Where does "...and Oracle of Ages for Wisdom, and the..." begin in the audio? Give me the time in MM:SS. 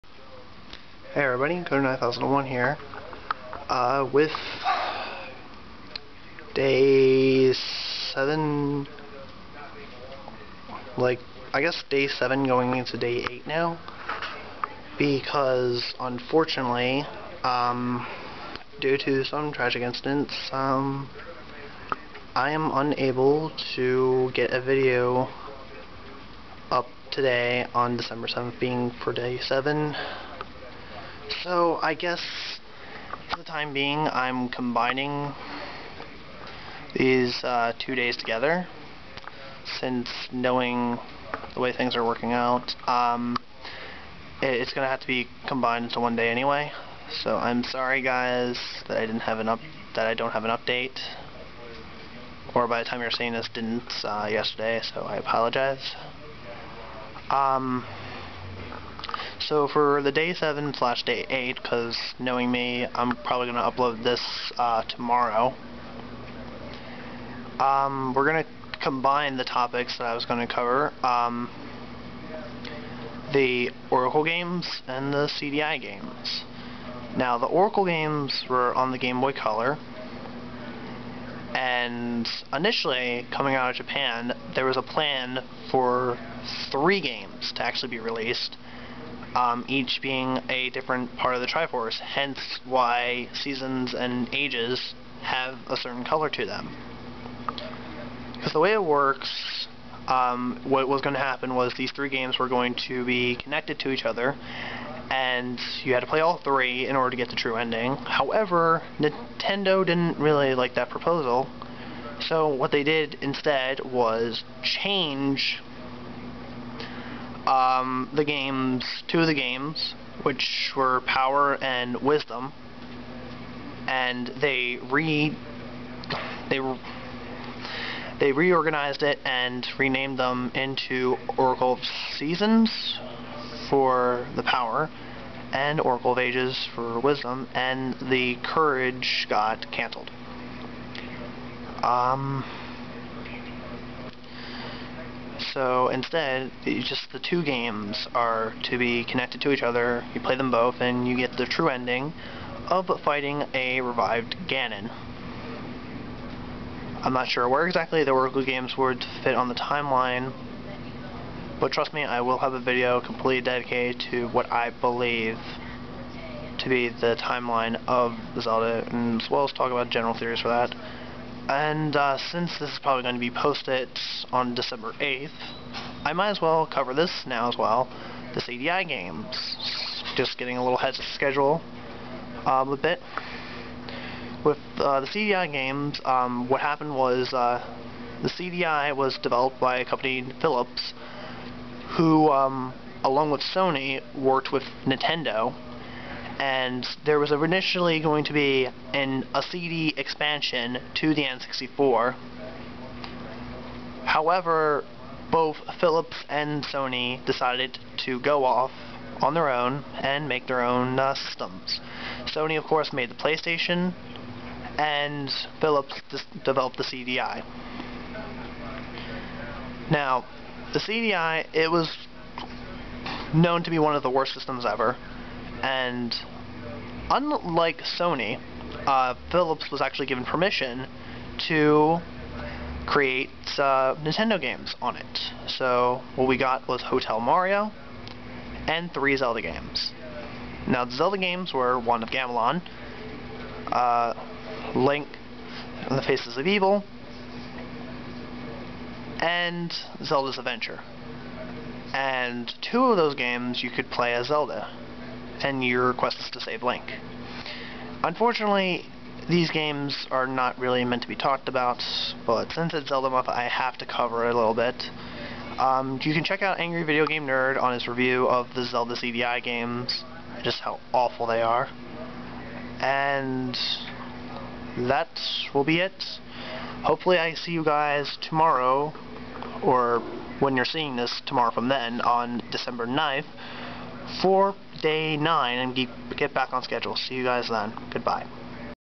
02:15.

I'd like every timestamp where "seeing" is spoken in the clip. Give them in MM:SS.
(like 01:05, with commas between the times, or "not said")
00:53, 04:40.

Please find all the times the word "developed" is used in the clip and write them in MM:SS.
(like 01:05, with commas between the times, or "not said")
03:09, 03:36.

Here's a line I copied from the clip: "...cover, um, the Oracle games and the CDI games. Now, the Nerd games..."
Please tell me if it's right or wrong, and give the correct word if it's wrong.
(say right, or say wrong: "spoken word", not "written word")
wrong: "Oracle", not "Nerd".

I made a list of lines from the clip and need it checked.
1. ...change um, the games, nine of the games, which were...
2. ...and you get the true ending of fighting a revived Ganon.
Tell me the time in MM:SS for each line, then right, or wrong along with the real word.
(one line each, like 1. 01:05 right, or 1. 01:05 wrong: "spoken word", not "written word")
1. 01:54 wrong: "two", not "nine"
2. 02:30 right.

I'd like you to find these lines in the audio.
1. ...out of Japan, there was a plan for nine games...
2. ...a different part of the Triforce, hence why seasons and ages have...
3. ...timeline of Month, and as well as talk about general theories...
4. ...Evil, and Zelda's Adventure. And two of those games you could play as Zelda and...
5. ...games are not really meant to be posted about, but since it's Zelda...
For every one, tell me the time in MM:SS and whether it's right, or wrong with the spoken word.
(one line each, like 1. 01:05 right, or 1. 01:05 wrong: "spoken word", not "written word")
1. 01:23 wrong: "three", not "nine"
2. 01:30 right
3. 02:47 wrong: "Zelda", not "Month"
4. 04:06 right
5. 04:19 wrong: "talked", not "posted".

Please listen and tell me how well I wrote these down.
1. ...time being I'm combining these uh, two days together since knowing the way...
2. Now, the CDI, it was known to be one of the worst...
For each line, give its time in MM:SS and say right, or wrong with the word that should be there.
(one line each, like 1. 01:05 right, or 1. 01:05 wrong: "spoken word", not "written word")
1. 00:33 right
2. 03:39 right.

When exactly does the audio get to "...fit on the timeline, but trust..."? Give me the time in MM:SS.
02:39.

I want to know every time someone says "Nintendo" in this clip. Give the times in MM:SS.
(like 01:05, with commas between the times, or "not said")
01:48, 03:14, 03:53.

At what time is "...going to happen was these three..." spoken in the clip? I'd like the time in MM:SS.
01:41.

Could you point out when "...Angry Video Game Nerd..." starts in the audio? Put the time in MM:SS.
04:26.